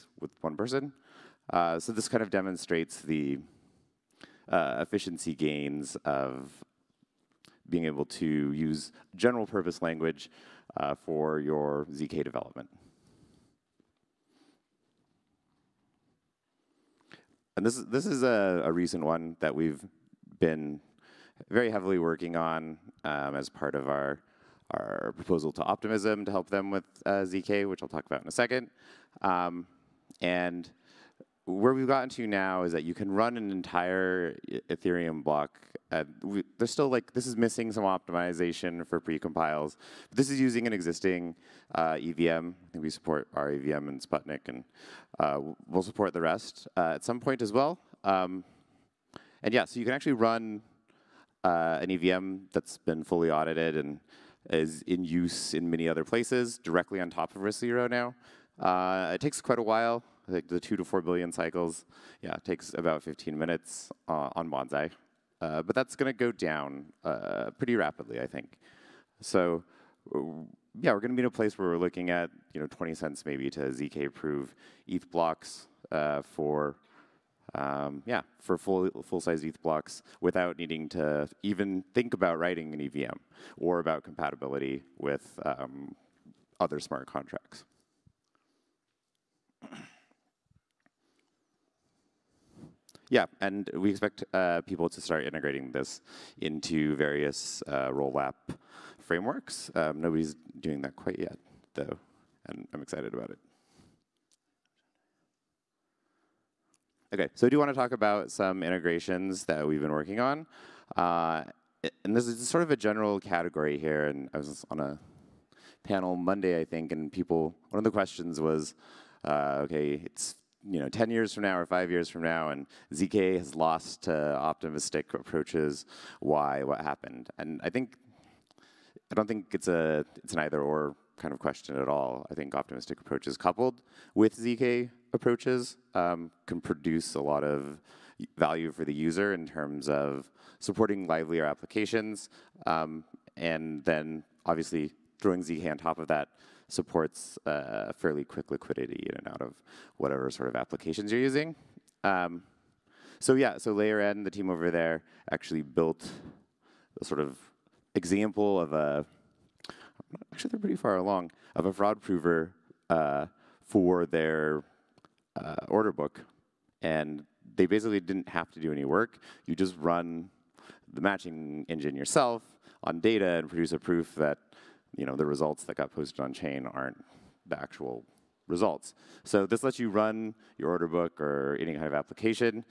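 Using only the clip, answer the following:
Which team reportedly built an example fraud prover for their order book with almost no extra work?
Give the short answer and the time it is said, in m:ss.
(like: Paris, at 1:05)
Layer N, at 2:33.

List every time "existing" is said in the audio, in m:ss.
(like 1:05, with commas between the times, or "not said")
0:40.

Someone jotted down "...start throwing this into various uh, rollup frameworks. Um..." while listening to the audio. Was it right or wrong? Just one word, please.
wrong.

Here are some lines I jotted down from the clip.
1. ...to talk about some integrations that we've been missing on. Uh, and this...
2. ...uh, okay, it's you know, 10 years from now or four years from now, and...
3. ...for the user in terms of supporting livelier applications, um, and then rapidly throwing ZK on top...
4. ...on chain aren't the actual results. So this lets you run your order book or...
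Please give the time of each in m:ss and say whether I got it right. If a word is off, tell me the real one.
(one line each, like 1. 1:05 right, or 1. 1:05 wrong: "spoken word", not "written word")
1. 1:47 wrong: "working", not "missing"
2. 1:59 wrong: "five", not "four"
3. 2:18 wrong: "obviously", not "rapidly"
4. 2:56 right.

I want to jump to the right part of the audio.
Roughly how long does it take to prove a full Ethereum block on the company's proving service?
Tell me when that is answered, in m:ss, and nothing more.
1:03.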